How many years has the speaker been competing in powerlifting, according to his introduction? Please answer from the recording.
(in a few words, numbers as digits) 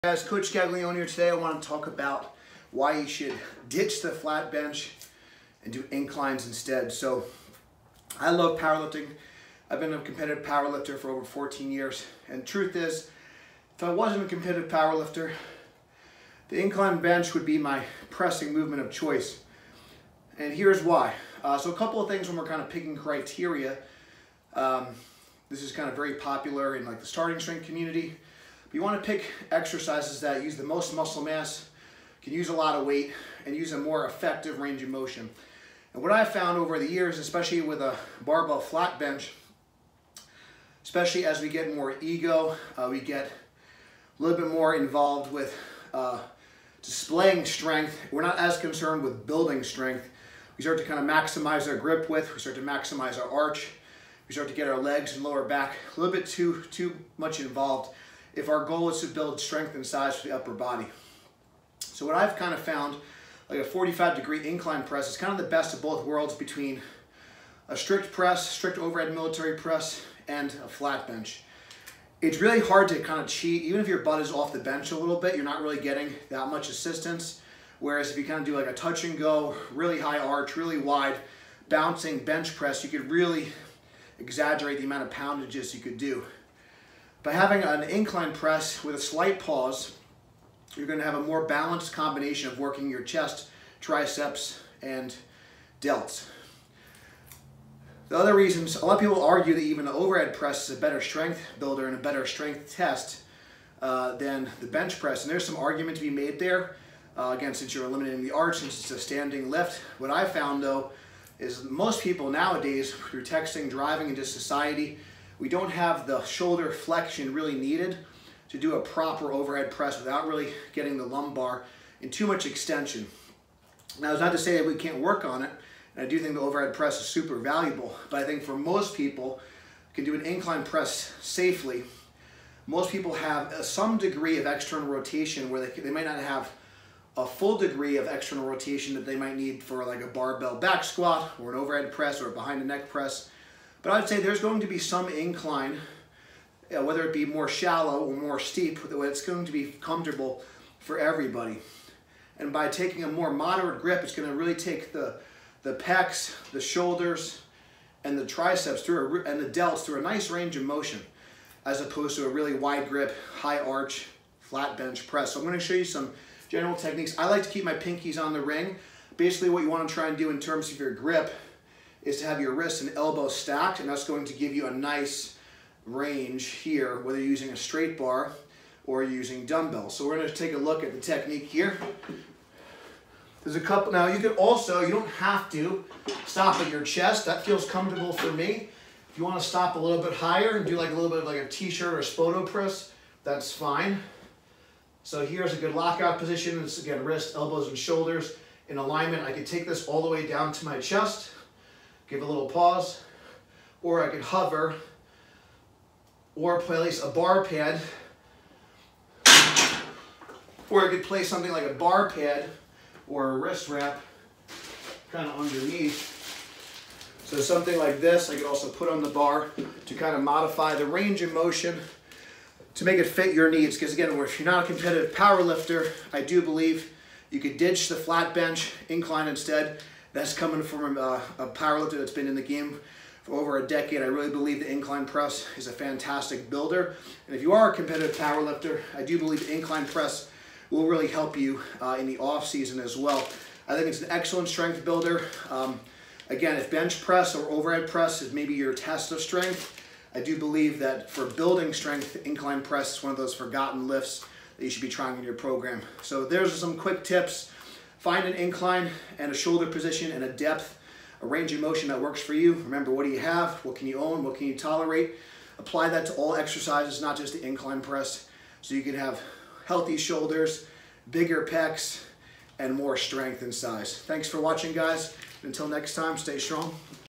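14.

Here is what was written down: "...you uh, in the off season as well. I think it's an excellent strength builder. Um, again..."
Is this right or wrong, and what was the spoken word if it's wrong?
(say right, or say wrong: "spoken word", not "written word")
right.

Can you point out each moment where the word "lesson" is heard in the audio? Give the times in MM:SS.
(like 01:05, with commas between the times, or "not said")
not said.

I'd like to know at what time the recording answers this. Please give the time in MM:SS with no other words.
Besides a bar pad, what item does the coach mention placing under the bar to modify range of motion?
03:33.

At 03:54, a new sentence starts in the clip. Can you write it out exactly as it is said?
I really believe the incline press is a fantastic builder.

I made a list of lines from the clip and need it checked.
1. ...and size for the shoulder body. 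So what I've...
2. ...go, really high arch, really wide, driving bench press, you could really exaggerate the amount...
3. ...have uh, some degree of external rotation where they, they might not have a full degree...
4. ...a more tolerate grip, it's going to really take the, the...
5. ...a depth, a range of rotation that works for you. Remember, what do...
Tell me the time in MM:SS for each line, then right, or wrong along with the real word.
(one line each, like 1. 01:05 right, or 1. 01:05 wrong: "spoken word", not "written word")
1. 00:59 wrong: "upper", not "shoulder"
2. 01:19 wrong: "bouncing", not "driving"
3. 02:13 right
4. 02:33 wrong: "moderate", not "tolerate"
5. 04:20 wrong: "motion", not "rotation".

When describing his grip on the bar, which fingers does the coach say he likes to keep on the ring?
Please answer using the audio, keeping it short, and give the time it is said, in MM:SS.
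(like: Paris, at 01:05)
Pinkies, at 02:47.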